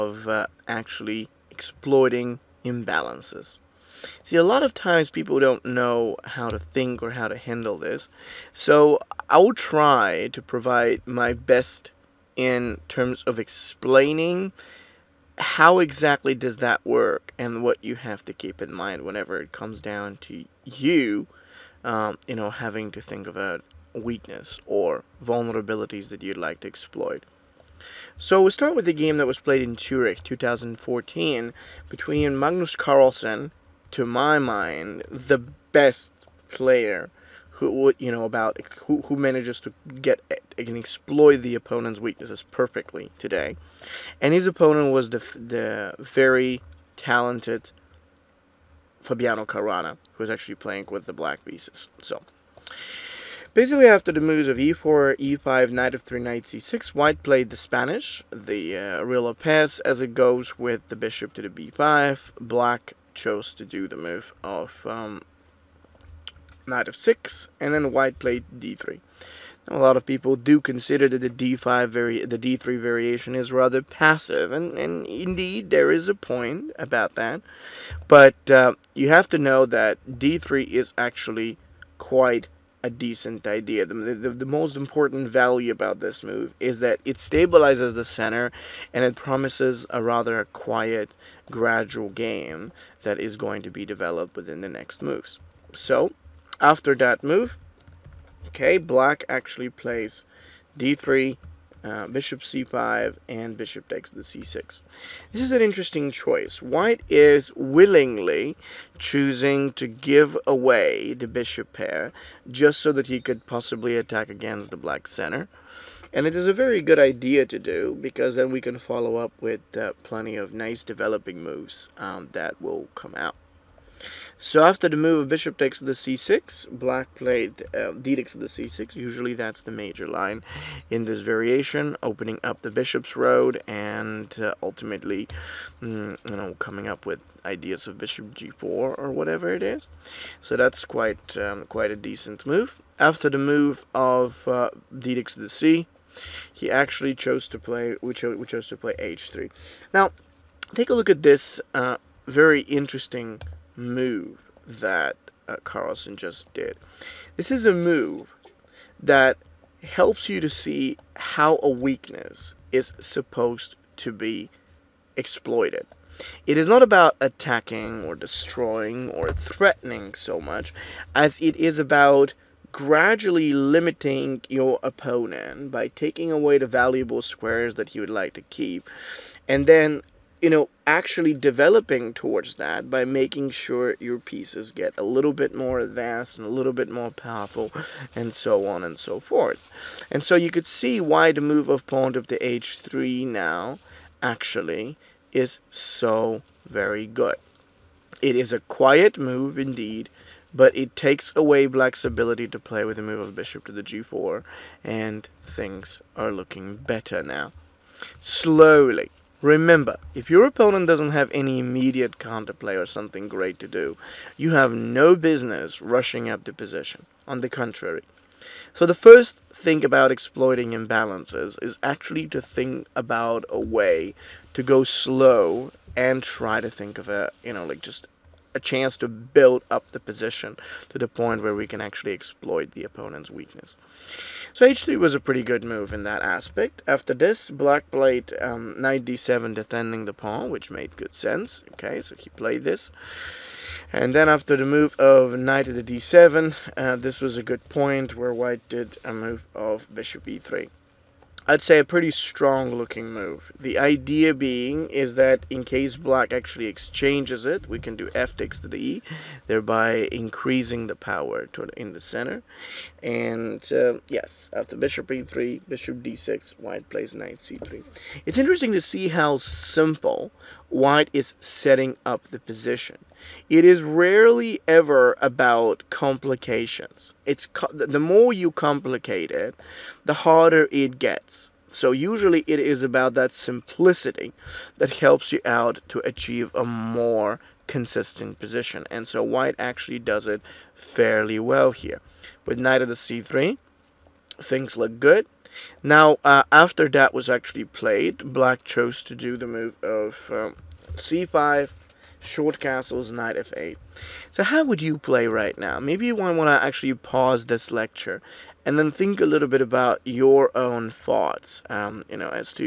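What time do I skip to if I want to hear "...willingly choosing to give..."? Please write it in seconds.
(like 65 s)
107 s.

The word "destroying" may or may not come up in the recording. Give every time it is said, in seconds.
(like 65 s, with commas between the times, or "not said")
168 s.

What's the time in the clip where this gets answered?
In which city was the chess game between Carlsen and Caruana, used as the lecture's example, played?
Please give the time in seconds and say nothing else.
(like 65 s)
29 s.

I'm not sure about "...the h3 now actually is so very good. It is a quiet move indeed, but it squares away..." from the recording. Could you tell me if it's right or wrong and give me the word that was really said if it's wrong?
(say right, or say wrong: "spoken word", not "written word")
wrong: "takes", not "squares".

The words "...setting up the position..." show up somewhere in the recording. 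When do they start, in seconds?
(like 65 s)
271 s.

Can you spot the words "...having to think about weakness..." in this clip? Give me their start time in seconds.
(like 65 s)
22 s.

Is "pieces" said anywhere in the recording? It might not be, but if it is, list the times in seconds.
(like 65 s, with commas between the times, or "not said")
51 s, 184 s.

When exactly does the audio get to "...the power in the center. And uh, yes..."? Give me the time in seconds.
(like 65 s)
260 s.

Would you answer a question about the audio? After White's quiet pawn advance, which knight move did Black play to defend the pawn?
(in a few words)
knight d7.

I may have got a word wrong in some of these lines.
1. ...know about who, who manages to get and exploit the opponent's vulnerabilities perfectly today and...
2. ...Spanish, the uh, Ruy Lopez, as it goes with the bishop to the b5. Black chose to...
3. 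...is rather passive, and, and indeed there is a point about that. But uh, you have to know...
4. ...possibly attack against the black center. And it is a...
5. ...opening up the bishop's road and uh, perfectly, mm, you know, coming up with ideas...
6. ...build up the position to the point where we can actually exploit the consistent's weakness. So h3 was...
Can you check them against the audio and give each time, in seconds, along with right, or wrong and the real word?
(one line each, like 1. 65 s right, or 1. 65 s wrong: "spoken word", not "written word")
1. 38 s wrong: "weaknesses", not "vulnerabilities"
2. 57 s right
3. 73 s right
4. 113 s right
5. 132 s wrong: "ultimately", not "perfectly"
6. 229 s wrong: "opponent", not "consistent".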